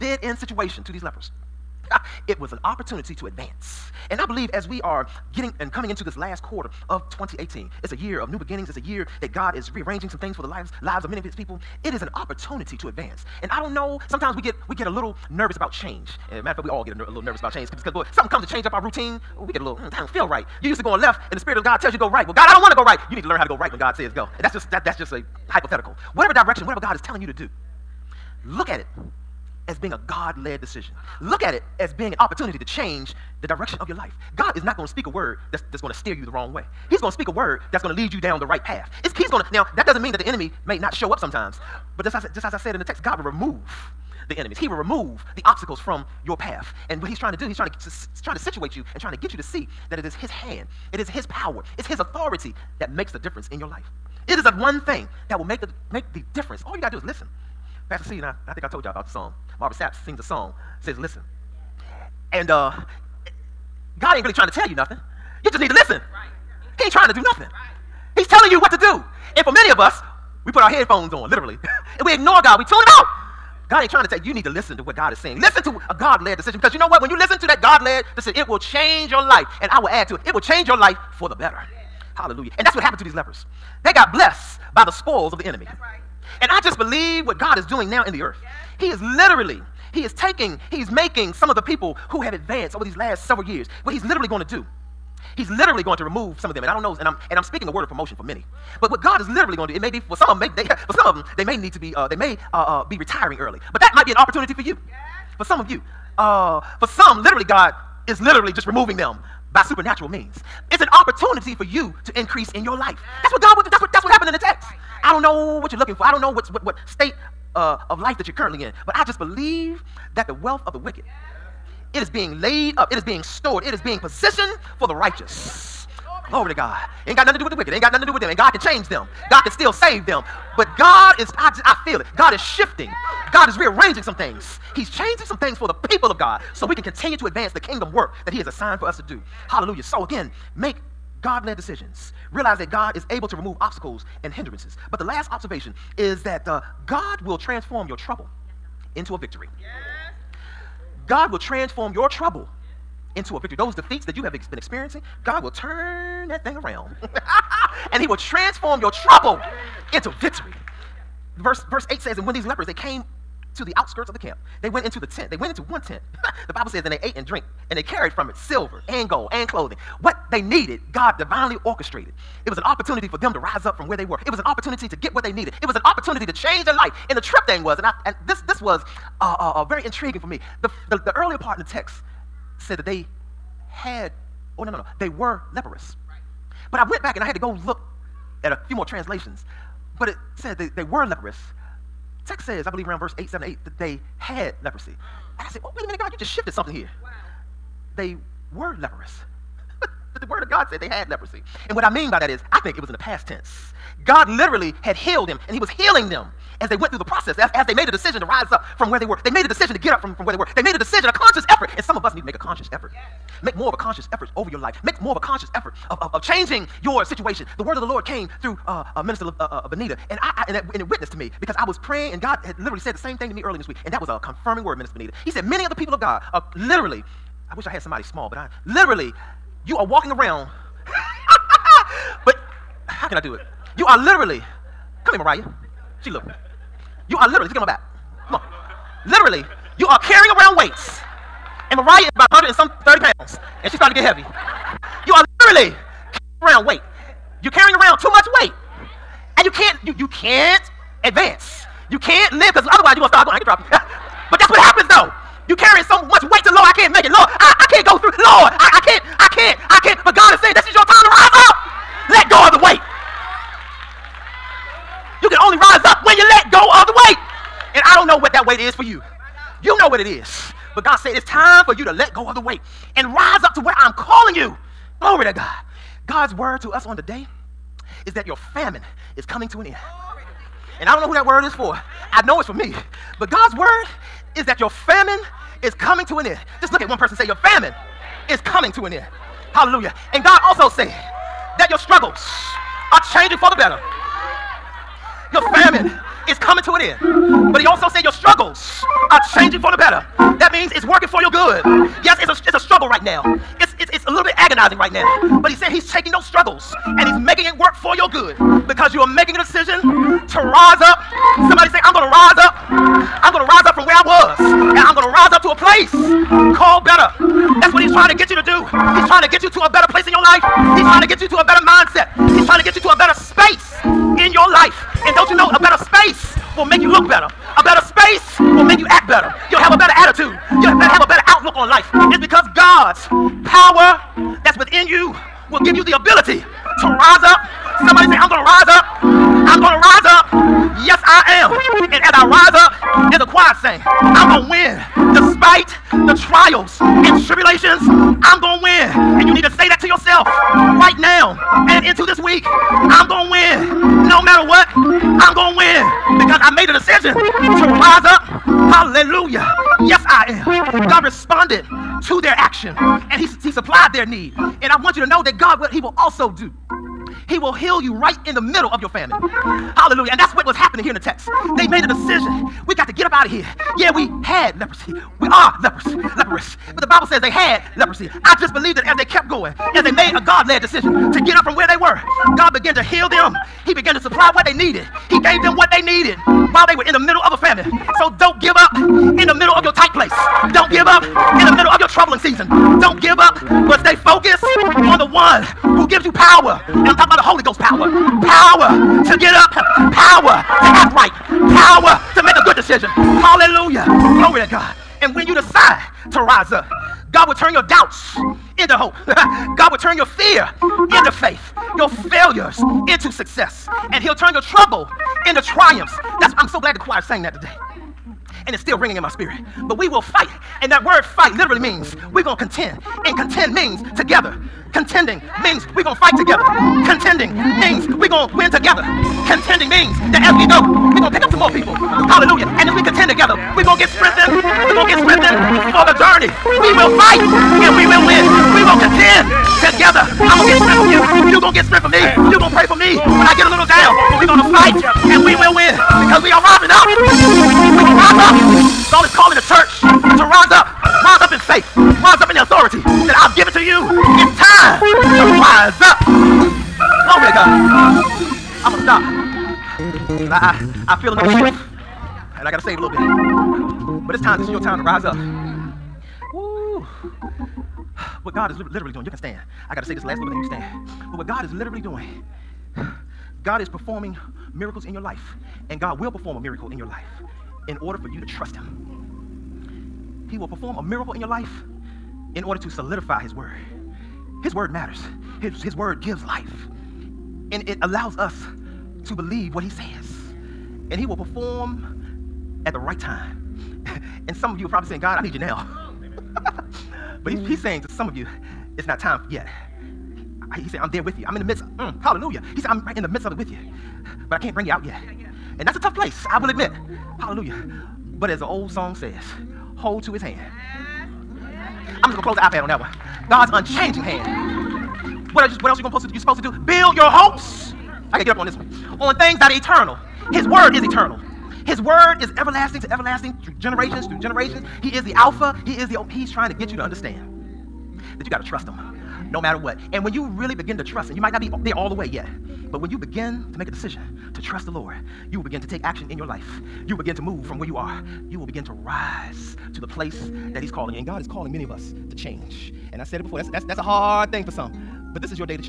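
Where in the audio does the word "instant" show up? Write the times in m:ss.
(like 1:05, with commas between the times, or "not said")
not said.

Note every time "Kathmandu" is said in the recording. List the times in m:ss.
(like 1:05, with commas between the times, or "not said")
not said.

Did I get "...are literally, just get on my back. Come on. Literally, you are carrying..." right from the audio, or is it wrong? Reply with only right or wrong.
right.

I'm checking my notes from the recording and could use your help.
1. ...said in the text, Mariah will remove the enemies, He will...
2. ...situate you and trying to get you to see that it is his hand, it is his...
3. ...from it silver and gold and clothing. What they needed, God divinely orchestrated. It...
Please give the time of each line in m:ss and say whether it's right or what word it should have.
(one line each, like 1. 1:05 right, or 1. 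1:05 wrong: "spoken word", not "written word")
1. 0:42 wrong: "God", not "Mariah"
2. 0:48 right
3. 2:48 right.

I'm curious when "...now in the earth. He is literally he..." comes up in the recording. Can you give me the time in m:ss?
1:27.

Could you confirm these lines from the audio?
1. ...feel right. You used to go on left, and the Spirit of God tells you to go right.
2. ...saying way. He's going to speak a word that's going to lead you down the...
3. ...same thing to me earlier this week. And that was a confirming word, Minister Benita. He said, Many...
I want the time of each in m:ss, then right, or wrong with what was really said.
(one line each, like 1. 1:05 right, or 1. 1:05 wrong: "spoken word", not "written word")
1. 0:20 right
2. 0:36 wrong: "wrong", not "saying"
3. 3:42 right.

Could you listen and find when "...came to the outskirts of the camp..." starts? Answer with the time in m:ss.
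2:42.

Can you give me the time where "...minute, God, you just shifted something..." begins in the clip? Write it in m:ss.
3:15.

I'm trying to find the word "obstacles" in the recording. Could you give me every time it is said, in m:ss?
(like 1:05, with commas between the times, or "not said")
0:45, 2:23.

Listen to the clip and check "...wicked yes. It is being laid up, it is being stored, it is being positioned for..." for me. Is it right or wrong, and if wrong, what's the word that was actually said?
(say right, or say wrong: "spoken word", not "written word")
right.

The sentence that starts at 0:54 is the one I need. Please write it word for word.
It is the one thing that will make the make the difference.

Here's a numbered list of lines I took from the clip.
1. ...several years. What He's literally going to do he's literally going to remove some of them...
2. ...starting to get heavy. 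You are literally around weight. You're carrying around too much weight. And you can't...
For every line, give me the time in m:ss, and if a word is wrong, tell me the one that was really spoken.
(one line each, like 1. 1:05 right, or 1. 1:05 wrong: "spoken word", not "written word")
1. 1:33 right
2. 4:03 right.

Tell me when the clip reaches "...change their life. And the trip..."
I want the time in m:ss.
2:56.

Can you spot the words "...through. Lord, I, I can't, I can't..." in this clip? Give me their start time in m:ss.
4:17.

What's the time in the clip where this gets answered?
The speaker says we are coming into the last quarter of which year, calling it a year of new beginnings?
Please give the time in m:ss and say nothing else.
0:07.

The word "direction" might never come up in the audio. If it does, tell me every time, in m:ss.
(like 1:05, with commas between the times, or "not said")
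0:26, 0:33.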